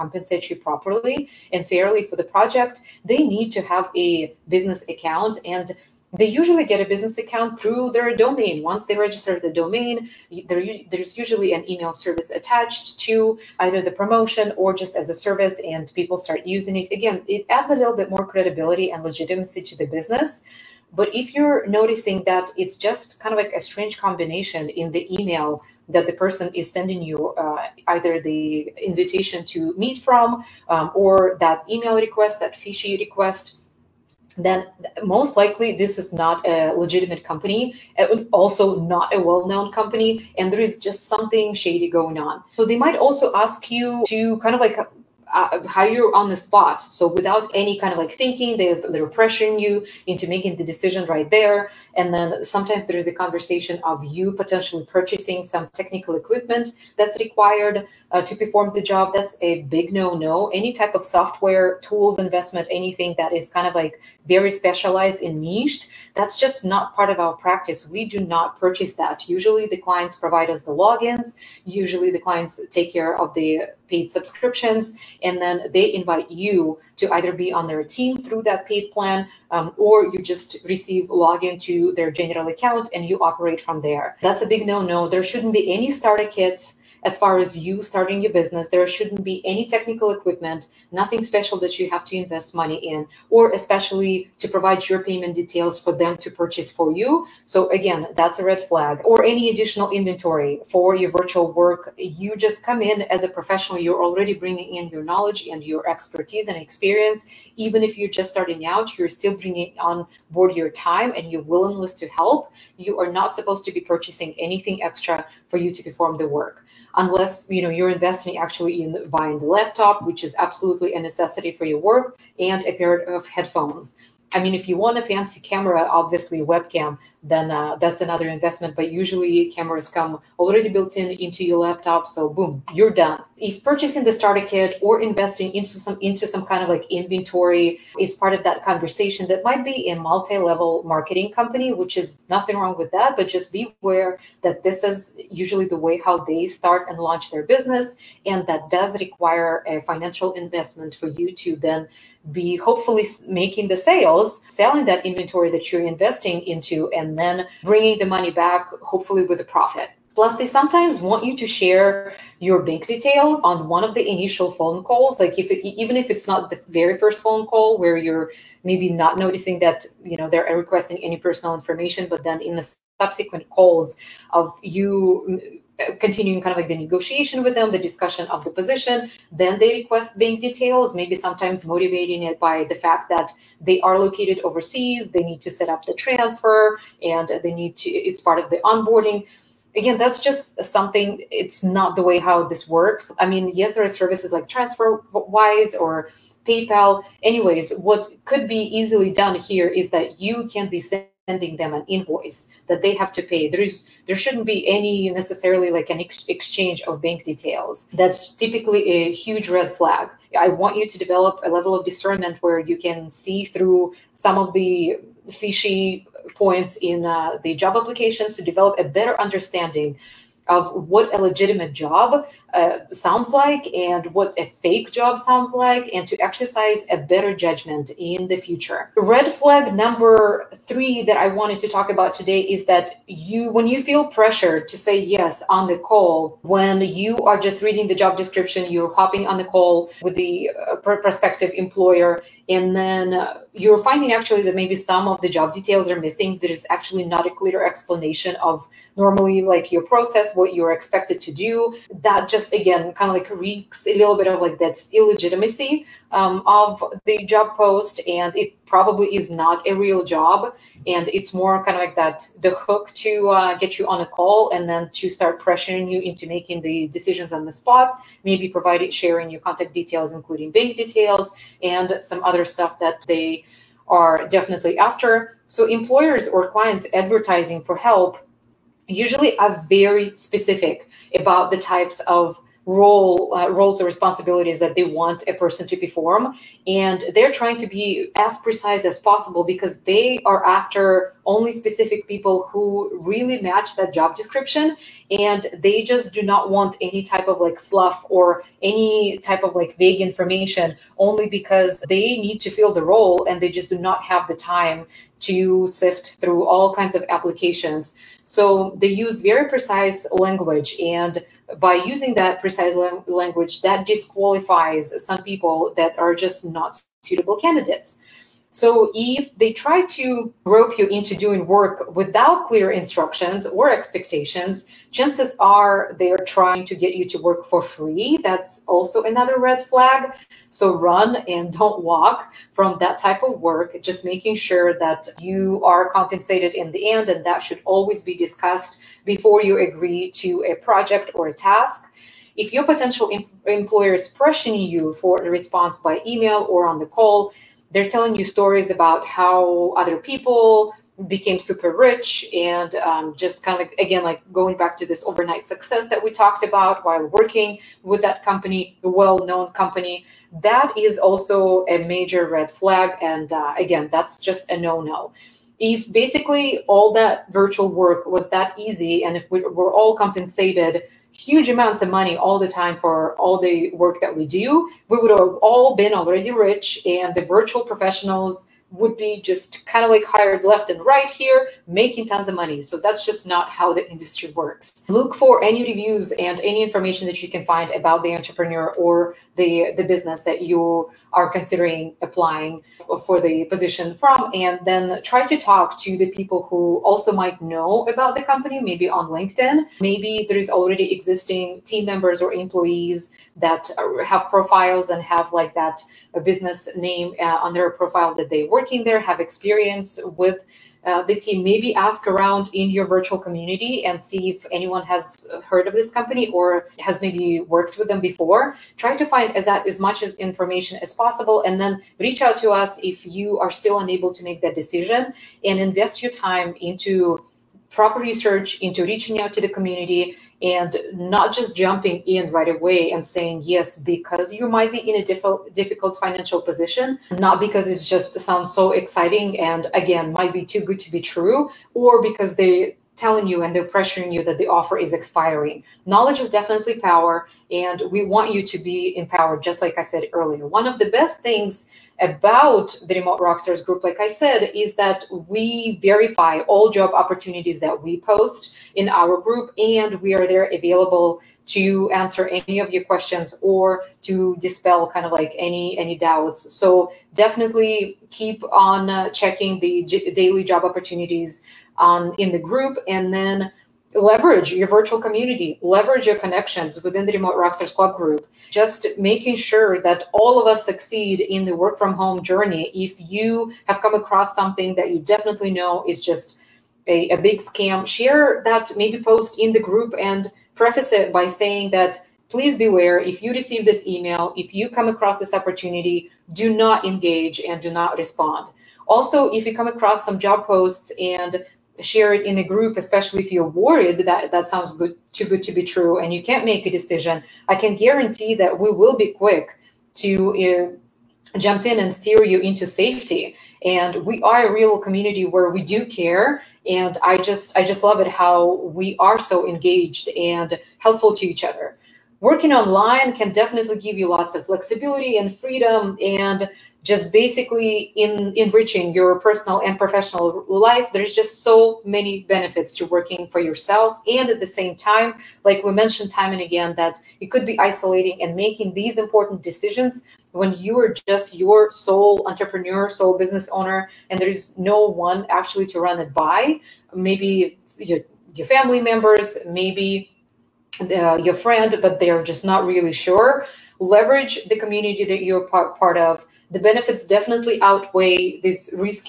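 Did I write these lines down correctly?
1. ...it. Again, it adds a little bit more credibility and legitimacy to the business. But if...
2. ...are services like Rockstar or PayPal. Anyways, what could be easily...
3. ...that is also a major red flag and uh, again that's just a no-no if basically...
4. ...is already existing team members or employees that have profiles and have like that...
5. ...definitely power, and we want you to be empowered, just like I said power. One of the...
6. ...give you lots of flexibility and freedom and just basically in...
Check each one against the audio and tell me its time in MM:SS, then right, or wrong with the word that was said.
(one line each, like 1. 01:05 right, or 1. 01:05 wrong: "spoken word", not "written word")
1. 00:16 right
2. 03:13 wrong: "TransferWise", not "Rockstar"
3. 06:00 right
4. 06:40 right
5. 07:26 wrong: "earlier", not "power"
6. 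08:43 right.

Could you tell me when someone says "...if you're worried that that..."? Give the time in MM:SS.
08:23.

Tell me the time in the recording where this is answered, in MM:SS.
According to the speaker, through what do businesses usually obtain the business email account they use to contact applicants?
00:07.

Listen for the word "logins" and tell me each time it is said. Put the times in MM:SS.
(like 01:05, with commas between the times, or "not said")
01:10, 01:21.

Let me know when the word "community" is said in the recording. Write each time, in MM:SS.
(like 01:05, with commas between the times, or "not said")
06:53, 07:09, 07:55, 08:34, 09:14.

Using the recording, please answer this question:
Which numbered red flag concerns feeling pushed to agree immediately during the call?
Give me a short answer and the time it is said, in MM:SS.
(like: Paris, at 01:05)
Number three, at 03:48.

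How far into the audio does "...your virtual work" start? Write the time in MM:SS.
01:40.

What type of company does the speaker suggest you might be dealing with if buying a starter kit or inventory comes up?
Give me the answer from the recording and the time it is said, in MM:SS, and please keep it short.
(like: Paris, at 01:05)
Multi-level marketing company, at 02:19.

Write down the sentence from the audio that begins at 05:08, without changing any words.
So they use very precise language.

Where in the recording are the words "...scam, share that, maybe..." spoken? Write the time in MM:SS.
08:07.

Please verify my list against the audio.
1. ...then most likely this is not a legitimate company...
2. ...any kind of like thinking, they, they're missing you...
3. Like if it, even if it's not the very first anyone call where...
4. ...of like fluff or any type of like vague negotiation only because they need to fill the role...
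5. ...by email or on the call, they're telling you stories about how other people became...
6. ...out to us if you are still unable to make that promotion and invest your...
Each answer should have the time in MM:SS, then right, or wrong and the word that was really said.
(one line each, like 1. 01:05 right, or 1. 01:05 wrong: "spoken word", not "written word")
1. 00:34 right
2. 00:47 wrong: "pressuring", not "missing"
3. 02:45 wrong: "phone", not "anyone"
4. 04:57 wrong: "information", not "negotiation"
5. 05:45 right
6. 07:02 wrong: "decision", not "promotion".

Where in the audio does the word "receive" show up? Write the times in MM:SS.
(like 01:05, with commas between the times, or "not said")
01:20, 08:13.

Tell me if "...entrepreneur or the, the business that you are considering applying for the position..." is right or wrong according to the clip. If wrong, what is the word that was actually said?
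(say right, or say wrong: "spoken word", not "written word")
right.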